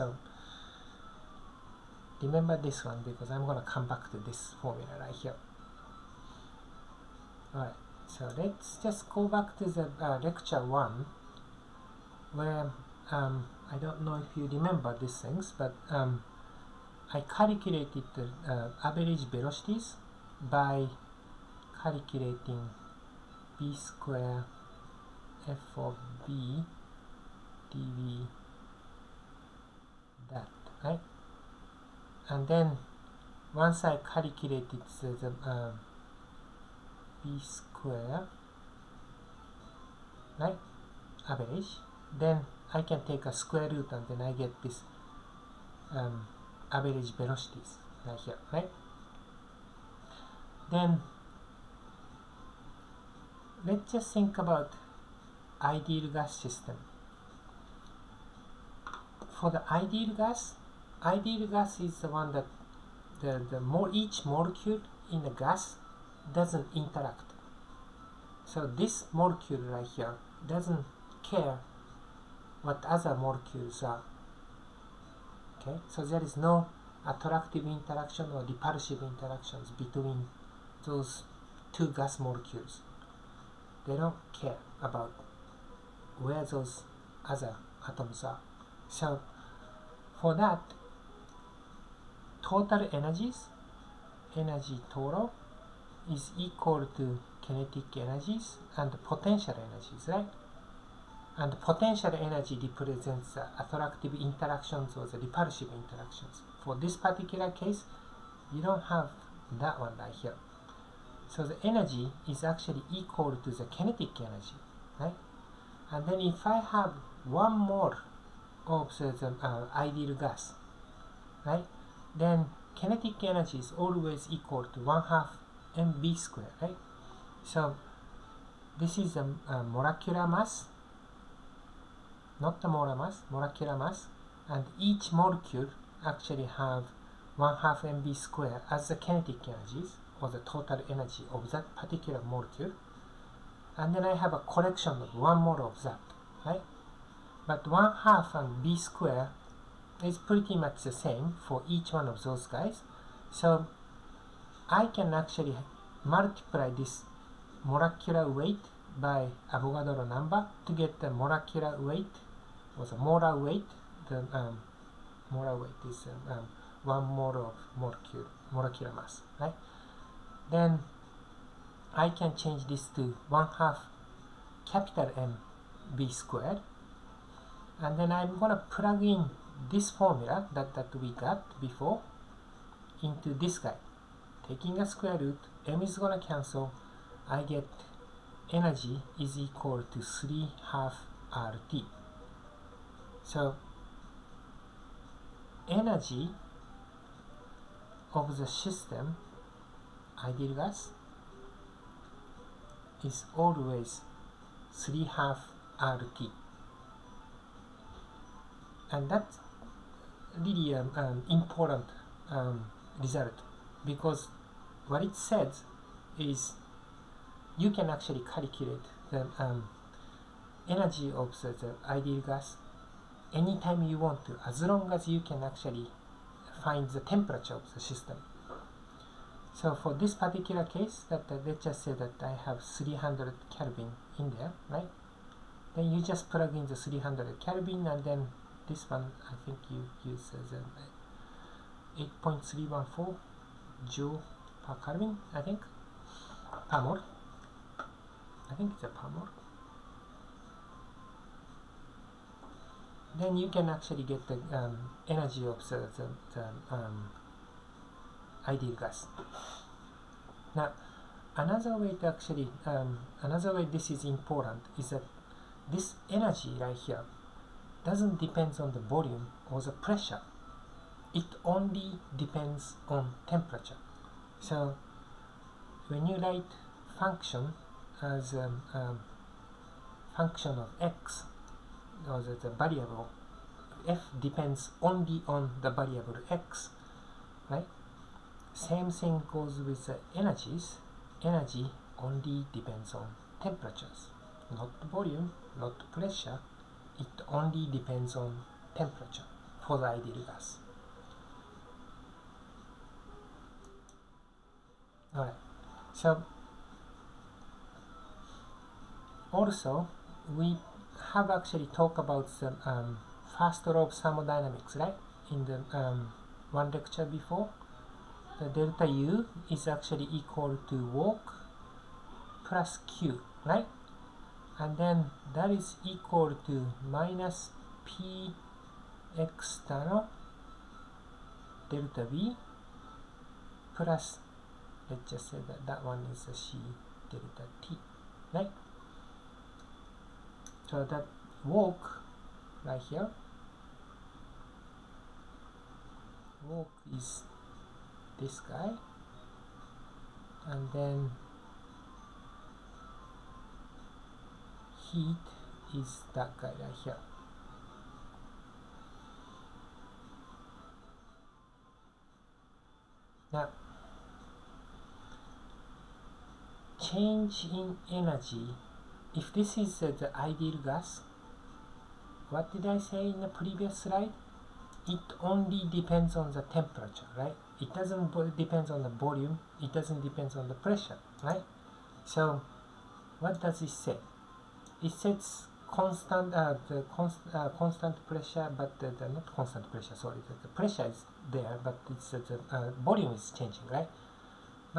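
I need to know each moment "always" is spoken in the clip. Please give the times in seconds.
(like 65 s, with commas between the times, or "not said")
123 s, 203 s.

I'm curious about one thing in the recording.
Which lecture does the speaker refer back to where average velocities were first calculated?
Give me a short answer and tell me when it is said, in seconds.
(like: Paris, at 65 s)
lecture 1, at 10 s.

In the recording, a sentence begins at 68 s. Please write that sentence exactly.
So this molecule right here doesn't care what other molecules are.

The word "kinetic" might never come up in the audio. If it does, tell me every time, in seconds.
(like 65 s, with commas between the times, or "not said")
97 s, 113 s, 122 s, 138 s.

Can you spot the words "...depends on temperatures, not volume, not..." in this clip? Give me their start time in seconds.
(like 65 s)
292 s.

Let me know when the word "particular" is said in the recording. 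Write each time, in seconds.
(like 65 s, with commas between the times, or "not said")
106 s, 141 s, 230 s.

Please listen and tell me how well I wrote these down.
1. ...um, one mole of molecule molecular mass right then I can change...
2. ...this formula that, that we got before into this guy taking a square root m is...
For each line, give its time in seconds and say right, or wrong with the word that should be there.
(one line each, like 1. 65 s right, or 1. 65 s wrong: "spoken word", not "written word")
1. 166 s right
2. 179 s right.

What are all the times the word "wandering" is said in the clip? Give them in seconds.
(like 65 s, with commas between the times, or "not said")
not said.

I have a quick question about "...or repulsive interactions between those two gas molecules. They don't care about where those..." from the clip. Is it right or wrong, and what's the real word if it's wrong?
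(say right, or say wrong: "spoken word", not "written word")
right.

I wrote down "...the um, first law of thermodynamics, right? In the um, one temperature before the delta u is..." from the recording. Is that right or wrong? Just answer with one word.
wrong.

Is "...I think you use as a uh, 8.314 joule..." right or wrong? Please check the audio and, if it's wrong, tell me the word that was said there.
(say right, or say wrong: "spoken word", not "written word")
right.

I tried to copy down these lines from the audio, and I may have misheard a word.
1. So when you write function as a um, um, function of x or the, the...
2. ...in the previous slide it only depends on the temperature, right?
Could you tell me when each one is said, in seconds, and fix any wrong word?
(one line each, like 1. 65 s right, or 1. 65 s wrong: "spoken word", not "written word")
1. 274 s right
2. 373 s right.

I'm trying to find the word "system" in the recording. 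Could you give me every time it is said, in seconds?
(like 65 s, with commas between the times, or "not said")
56 s, 198 s, 227 s.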